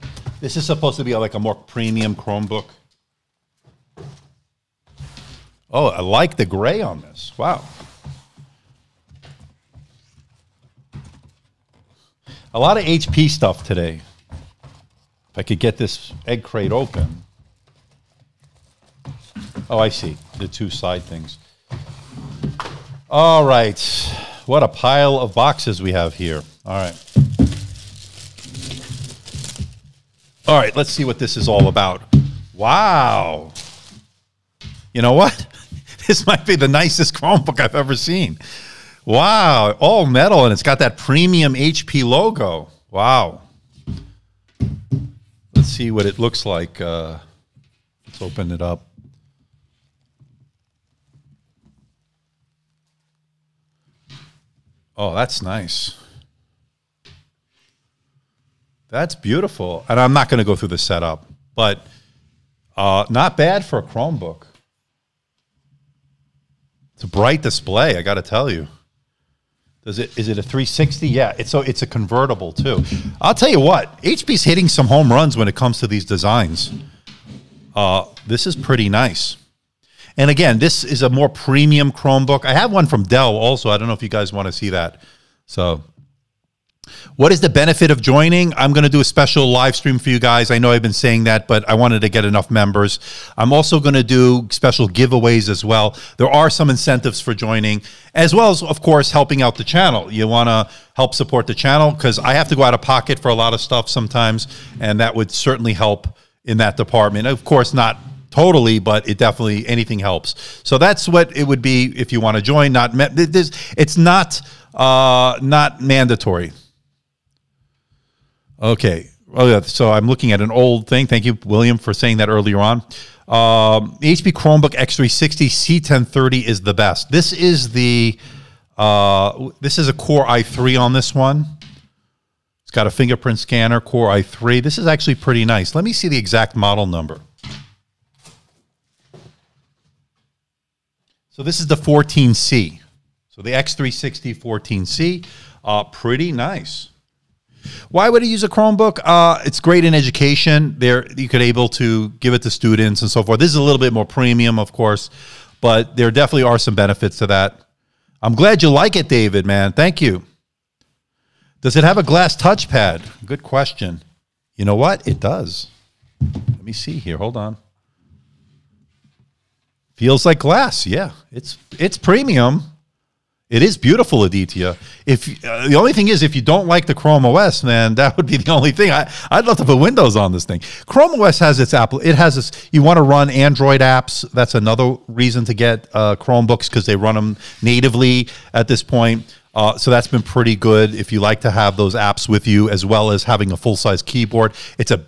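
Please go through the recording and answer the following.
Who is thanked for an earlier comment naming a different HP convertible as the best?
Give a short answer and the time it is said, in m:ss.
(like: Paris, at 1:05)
William, at 2:01.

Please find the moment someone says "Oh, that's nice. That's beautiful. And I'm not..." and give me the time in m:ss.
0:54.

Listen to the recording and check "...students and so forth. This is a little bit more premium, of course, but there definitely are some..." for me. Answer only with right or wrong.
right.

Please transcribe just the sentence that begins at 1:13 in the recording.
I'll tell you what, HP's hitting some home runs when it comes to these designs.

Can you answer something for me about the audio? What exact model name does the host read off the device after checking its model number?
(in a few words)
X360 14C.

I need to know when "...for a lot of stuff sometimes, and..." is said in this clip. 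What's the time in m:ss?
1:43.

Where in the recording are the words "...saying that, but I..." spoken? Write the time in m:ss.
1:30.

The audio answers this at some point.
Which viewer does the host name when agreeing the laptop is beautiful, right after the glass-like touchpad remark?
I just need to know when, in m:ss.
2:54.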